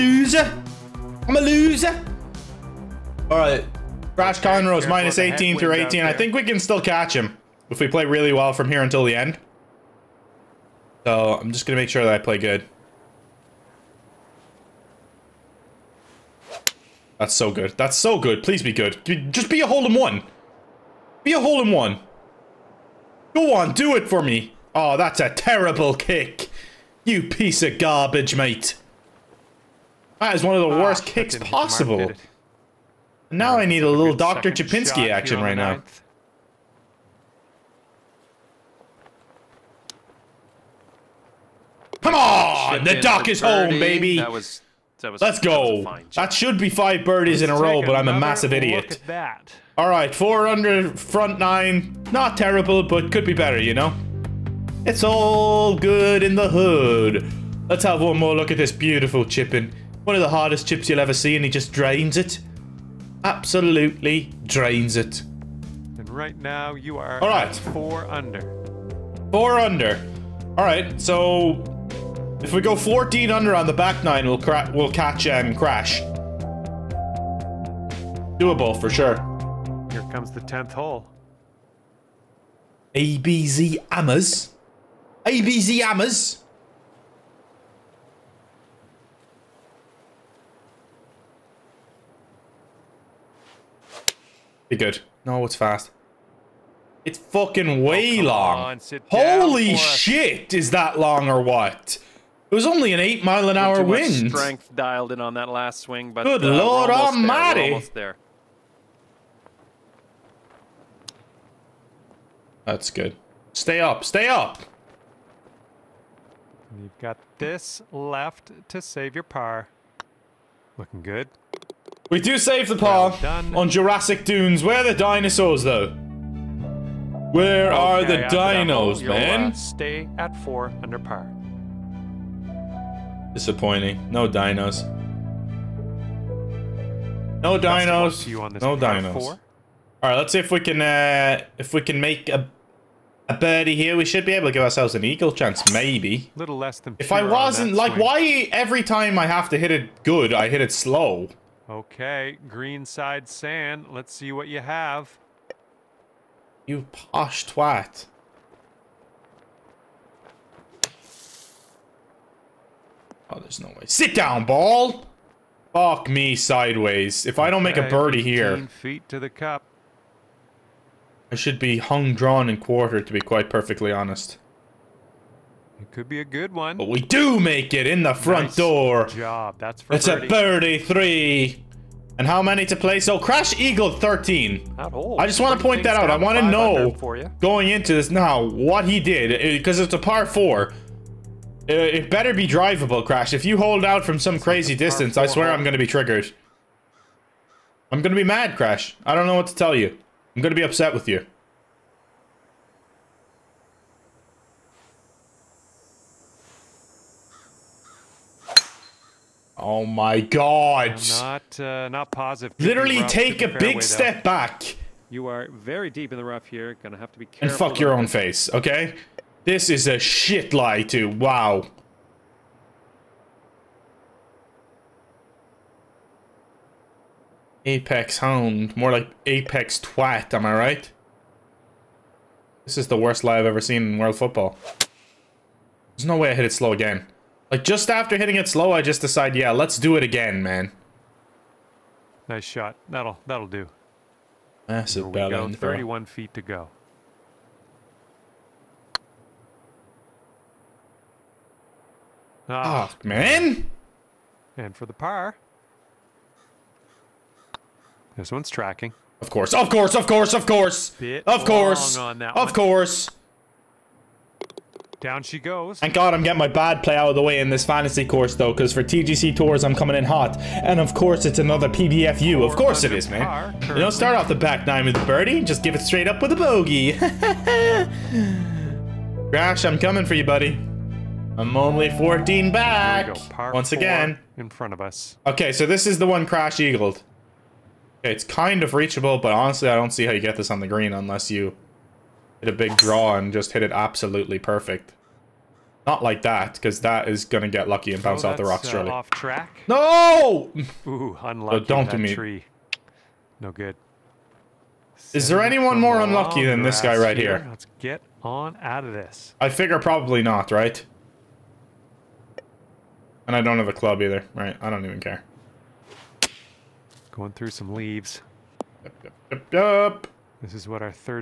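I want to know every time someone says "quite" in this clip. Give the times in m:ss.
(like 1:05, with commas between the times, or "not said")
2:53.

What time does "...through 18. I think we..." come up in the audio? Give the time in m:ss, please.
0:05.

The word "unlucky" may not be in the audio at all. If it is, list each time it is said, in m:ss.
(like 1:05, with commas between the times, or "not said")
5:01, 5:06.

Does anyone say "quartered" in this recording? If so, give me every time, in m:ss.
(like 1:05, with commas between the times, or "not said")
2:52.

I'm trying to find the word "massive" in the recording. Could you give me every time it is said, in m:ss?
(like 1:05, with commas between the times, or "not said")
0:48, 4:04.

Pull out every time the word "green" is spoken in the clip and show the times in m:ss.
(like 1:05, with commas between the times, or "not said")
2:32, 4:50.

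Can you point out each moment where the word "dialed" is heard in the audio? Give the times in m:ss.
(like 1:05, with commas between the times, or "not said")
1:44.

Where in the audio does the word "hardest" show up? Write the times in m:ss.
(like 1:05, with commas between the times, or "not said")
1:00.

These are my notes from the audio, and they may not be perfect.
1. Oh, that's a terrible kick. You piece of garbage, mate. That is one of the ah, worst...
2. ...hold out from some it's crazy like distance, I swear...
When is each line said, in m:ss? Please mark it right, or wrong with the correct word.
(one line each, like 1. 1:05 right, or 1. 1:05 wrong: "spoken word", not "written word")
1. 0:24 right
2. 3:13 right.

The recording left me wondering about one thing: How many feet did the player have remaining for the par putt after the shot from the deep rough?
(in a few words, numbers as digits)
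31 feet.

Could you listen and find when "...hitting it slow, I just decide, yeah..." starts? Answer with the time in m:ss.
3:58.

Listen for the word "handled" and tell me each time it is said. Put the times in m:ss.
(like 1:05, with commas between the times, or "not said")
not said.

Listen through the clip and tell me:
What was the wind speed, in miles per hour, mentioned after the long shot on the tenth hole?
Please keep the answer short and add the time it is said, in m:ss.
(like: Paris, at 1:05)
8, at 1:42.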